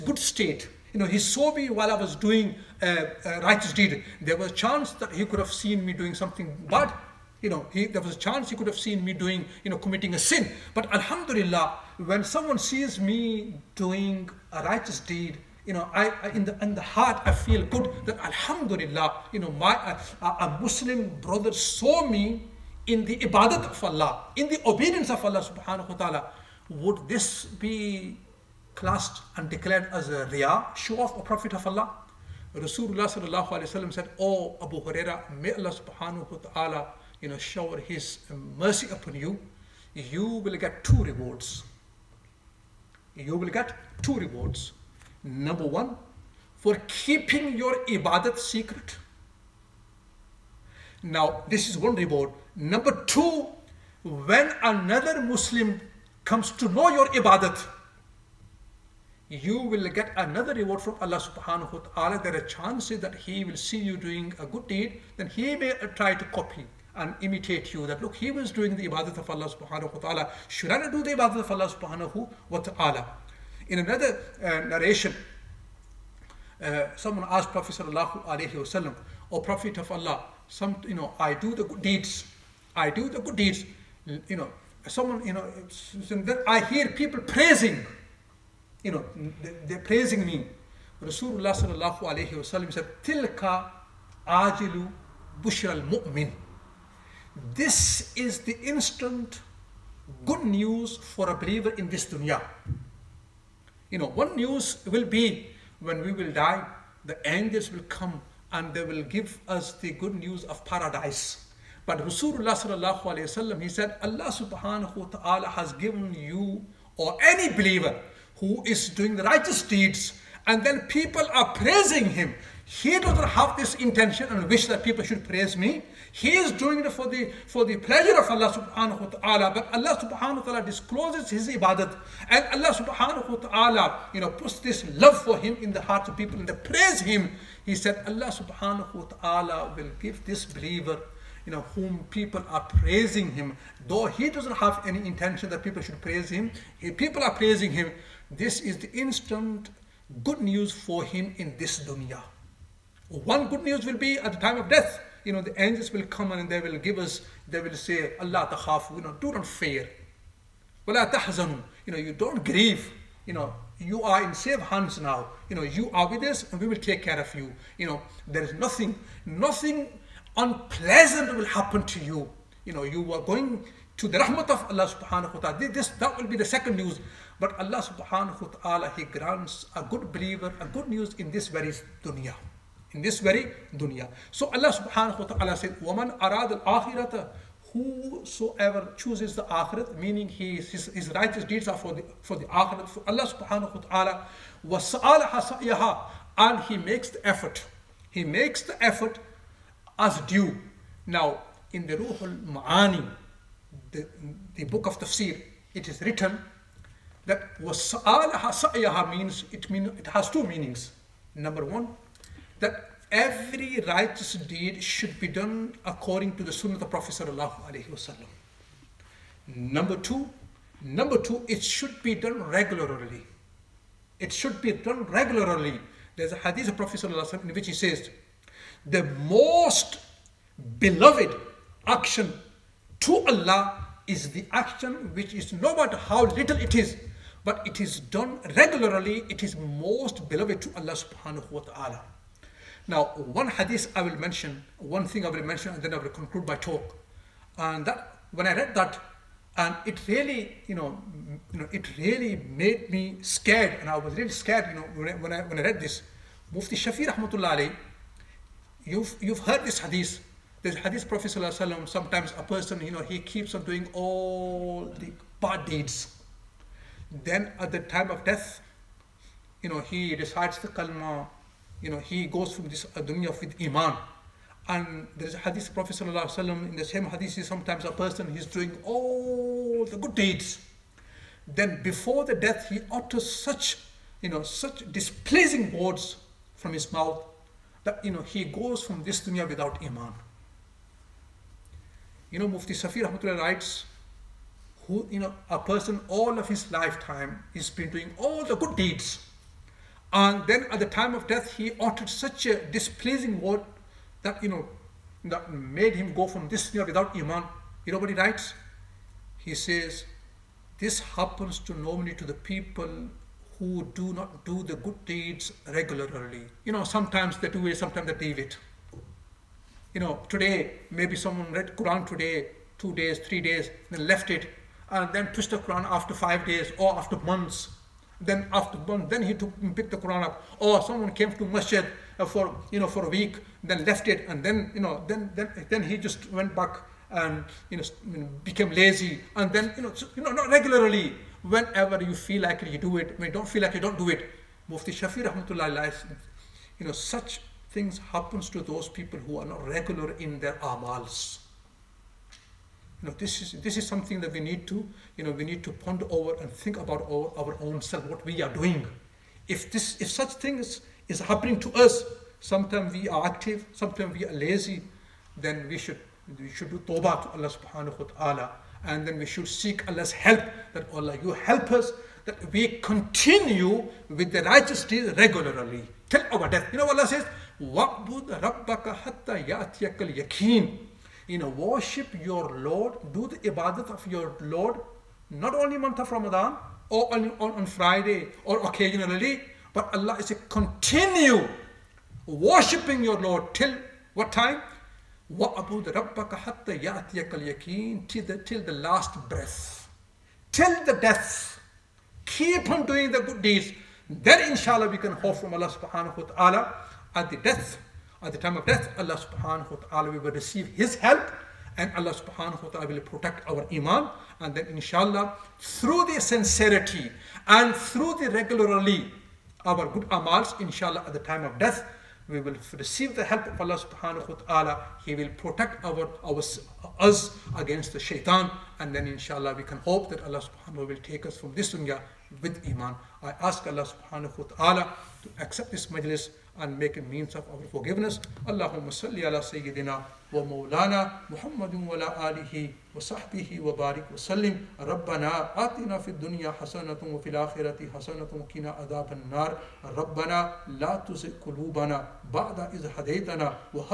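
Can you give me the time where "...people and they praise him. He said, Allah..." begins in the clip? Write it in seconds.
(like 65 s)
136 s.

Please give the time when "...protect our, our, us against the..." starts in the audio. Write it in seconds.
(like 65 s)
425 s.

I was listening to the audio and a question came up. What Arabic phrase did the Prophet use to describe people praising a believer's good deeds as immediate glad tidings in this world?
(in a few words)
Tilka ajilu bushra al-mu'min.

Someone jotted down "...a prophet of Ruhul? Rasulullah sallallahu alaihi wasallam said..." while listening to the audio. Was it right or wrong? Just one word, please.
wrong.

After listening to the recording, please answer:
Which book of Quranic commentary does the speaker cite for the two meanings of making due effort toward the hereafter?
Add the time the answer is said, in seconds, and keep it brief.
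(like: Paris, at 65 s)
Ruhul Ma'ani, at 201 s.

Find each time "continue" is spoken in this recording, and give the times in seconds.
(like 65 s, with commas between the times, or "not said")
372 s, 390 s.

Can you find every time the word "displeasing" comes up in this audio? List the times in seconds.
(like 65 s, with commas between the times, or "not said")
284 s, 302 s.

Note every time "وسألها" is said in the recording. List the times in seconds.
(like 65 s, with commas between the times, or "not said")
195 s, 207 s.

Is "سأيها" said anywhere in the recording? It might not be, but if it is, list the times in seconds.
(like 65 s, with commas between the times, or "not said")
195 s, 208 s.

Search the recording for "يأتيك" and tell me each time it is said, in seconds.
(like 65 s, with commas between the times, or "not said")
379 s, 396 s.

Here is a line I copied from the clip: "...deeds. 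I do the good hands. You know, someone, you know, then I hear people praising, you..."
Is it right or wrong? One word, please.
wrong.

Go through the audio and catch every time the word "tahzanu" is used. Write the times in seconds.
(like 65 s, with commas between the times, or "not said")
161 s.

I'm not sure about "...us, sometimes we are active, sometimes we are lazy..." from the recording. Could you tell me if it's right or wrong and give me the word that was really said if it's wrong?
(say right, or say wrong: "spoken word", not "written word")
right.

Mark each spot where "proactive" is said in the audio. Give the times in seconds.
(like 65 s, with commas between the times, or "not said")
not said.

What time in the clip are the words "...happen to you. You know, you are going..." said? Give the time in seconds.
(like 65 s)
171 s.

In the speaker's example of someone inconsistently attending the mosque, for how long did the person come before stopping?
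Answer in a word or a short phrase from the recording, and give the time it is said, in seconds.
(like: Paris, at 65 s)
a week, at 333 s.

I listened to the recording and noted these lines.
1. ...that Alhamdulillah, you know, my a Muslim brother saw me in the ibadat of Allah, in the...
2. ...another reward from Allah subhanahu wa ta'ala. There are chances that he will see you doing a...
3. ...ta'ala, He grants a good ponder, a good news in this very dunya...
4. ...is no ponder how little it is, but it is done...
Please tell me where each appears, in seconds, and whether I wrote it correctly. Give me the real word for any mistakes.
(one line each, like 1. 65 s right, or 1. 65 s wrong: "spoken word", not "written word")
1. 18 s right
2. 60 s right
3. 178 s wrong: "believer", not "ponder"
4. 235 s wrong: "matter", not "ponder".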